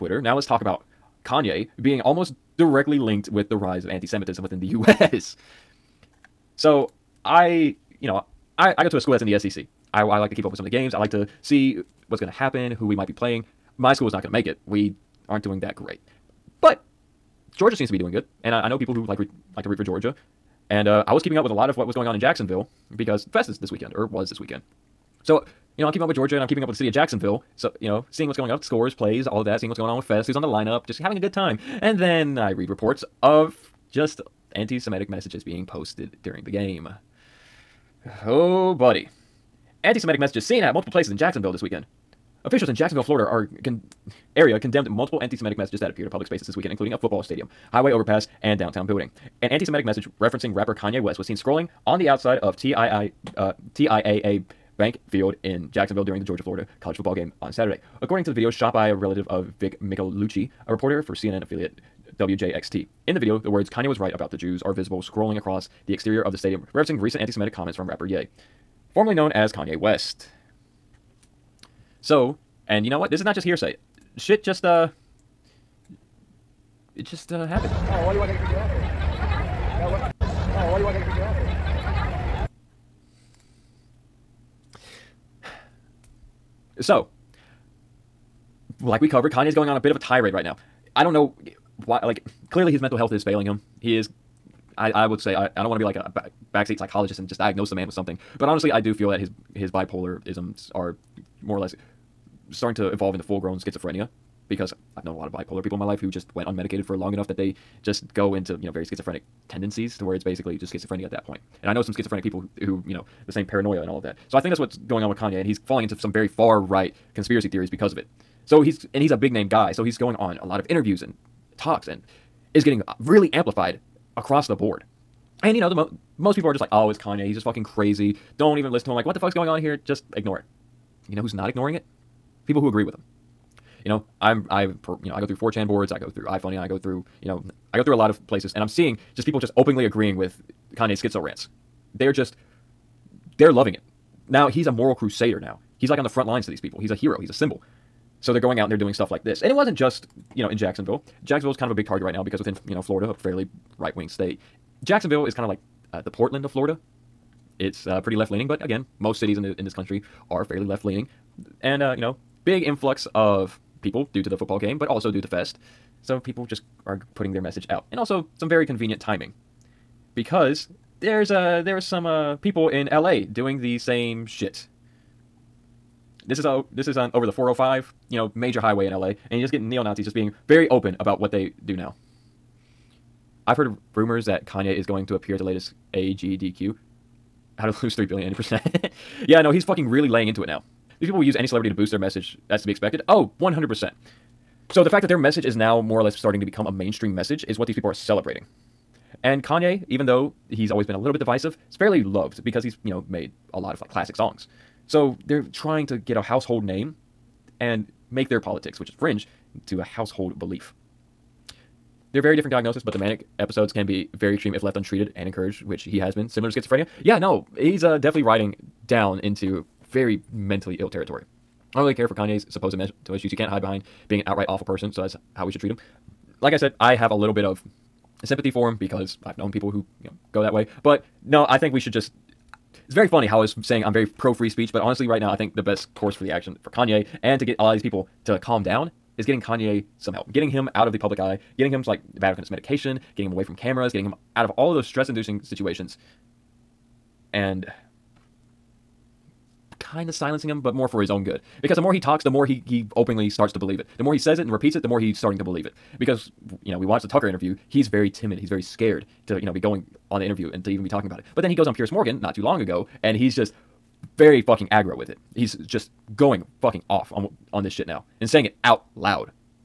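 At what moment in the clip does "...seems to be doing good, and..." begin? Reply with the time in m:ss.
0:17.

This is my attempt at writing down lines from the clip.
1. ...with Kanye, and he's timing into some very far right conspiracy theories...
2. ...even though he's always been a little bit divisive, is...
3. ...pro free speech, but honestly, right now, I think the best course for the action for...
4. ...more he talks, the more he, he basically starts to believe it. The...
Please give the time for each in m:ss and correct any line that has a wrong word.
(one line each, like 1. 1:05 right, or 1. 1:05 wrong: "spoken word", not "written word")
1. 1:55 wrong: "falling", not "timing"
2. 3:19 right
3. 3:54 right
4. 4:11 wrong: "openly", not "basically".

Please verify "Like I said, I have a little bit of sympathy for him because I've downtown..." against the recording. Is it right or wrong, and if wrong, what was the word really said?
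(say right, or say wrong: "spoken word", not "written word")
wrong: "known", not "downtown".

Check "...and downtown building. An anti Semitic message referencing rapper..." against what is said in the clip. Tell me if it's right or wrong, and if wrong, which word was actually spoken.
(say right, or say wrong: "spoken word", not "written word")
right.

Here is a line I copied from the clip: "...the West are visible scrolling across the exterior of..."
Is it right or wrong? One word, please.
wrong.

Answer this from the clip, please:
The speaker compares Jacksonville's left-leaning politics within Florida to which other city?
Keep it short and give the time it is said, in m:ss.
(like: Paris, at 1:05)
Portland, at 2:36.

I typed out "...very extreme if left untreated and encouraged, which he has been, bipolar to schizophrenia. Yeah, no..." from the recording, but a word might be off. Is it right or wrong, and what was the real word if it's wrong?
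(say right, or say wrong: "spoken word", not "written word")
wrong: "similar", not "bipolar".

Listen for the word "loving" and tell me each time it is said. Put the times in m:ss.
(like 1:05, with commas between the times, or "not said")
2:23.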